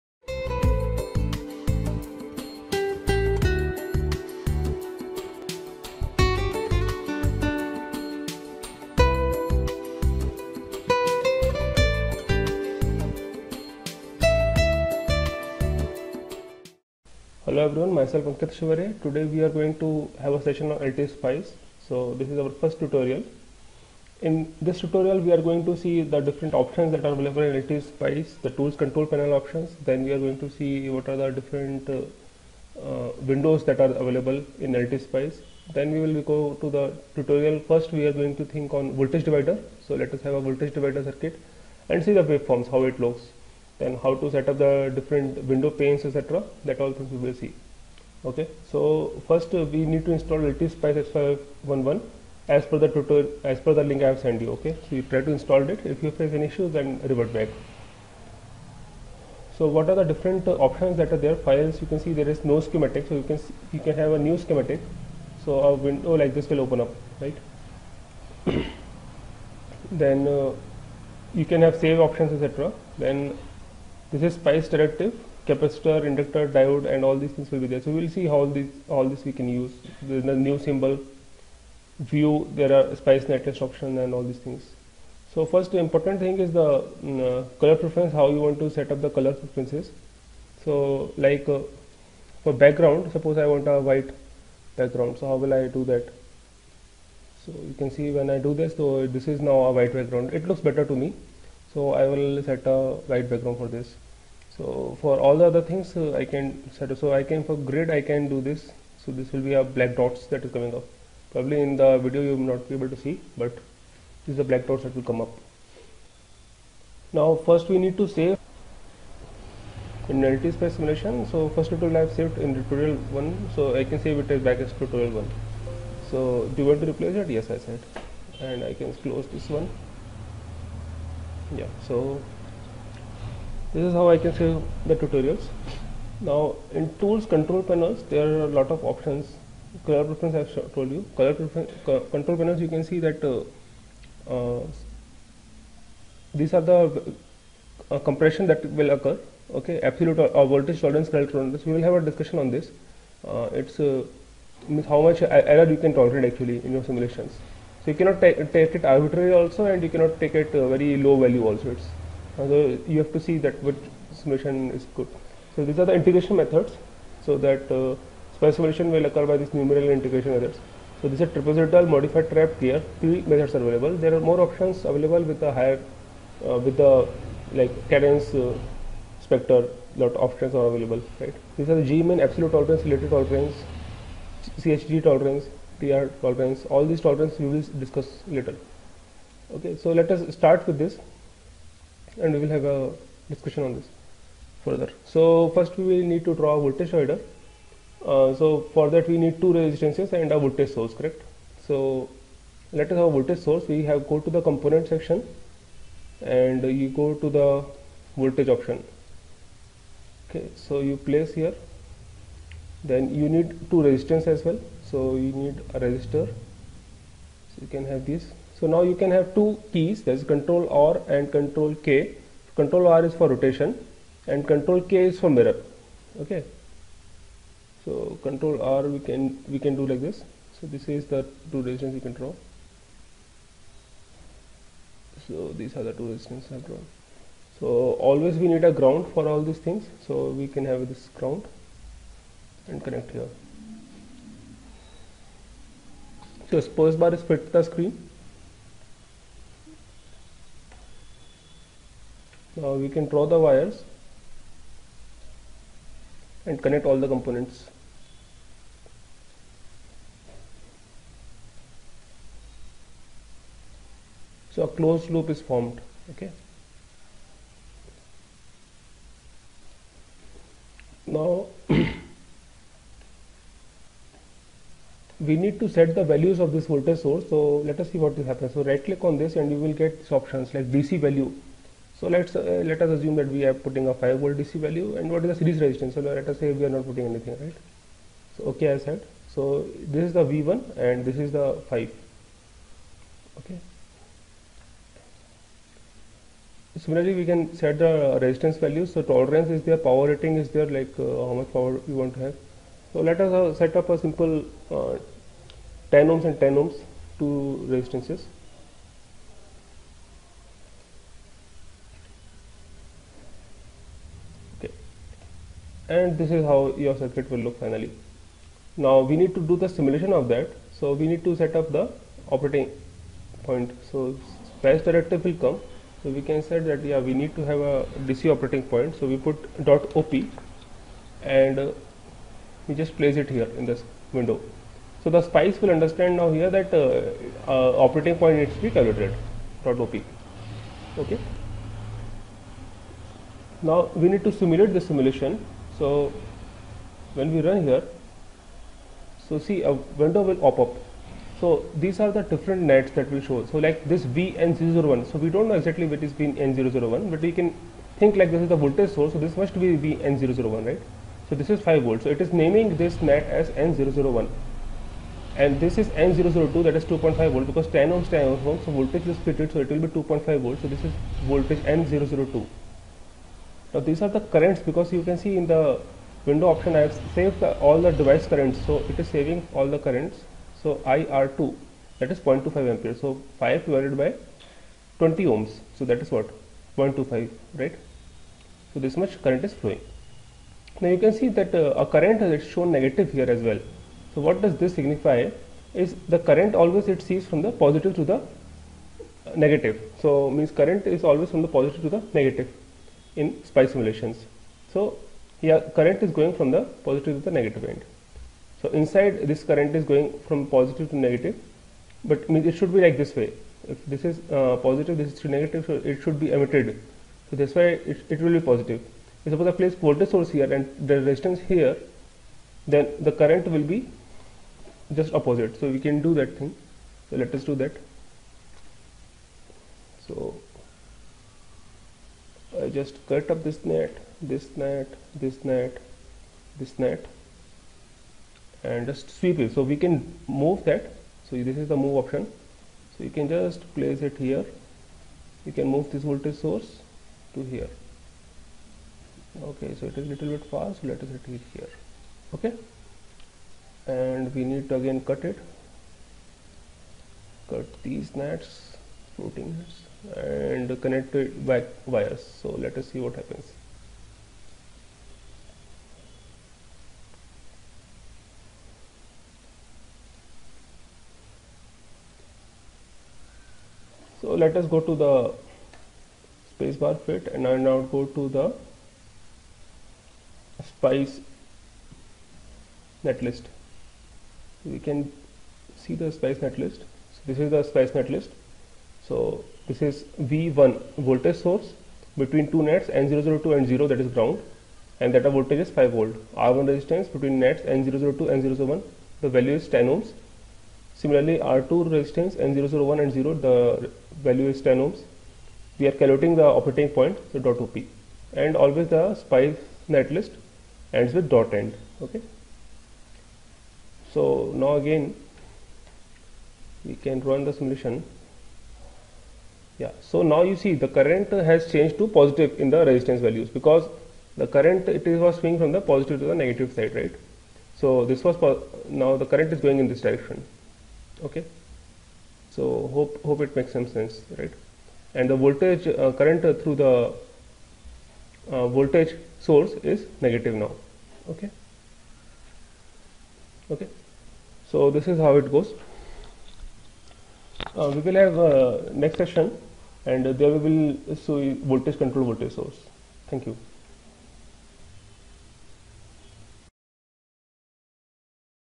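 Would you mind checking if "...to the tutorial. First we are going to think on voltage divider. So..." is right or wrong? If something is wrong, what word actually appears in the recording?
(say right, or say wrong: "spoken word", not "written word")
right.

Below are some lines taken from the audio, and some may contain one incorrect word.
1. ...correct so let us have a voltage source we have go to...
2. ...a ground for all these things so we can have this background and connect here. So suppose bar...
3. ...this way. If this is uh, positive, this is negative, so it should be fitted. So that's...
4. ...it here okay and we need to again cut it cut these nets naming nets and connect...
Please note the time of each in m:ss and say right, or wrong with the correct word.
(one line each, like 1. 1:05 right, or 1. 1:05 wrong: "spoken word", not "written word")
1. 3:20 right
2. 3:58 wrong: "ground", not "background"
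3. 6:52 wrong: "emitted", not "fitted"
4. 7:31 wrong: "floating", not "naming".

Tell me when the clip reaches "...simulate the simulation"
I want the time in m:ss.
5:44.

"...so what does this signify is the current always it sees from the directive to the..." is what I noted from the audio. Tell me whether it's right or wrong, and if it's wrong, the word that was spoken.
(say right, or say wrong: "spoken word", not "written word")
wrong: "positive", not "directive".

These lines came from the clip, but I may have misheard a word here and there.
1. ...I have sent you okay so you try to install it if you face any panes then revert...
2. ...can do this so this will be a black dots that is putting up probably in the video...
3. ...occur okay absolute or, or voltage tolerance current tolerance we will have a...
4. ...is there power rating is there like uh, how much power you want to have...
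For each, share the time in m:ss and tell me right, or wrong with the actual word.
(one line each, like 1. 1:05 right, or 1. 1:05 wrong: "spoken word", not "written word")
1. 0:54 wrong: "issues", not "panes"
2. 1:48 wrong: "coming", not "putting"
3. 2:28 right
4. 4:59 right.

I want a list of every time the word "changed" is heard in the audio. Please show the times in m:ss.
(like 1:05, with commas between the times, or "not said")
8:41.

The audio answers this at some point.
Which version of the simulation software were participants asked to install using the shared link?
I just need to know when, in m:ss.
0:50.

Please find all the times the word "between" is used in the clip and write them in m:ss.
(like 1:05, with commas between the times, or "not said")
8:12, 8:17.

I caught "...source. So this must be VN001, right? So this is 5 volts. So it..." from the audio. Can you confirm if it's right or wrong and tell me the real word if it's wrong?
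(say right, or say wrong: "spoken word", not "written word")
right.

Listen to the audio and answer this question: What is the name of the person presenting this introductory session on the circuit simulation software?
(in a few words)
Ankit Shivare.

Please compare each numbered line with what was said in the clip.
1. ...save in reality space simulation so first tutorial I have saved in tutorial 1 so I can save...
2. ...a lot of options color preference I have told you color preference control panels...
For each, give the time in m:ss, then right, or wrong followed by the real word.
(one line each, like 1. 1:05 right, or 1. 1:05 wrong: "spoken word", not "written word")
1. 1:58 right
2. 2:18 right.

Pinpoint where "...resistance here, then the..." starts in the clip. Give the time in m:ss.
7:00.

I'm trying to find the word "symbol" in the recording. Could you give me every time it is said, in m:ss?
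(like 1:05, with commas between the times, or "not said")
1:20.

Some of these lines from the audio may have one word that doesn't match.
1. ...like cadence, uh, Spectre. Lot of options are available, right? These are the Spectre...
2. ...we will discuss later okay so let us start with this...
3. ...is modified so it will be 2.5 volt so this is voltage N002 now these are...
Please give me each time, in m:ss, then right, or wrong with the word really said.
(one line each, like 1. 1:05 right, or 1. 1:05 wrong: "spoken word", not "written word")
1. 2:57 wrong: "Gmin", not "Spectre"
2. 3:07 right
3. 6:09 wrong: "fitted", not "modified".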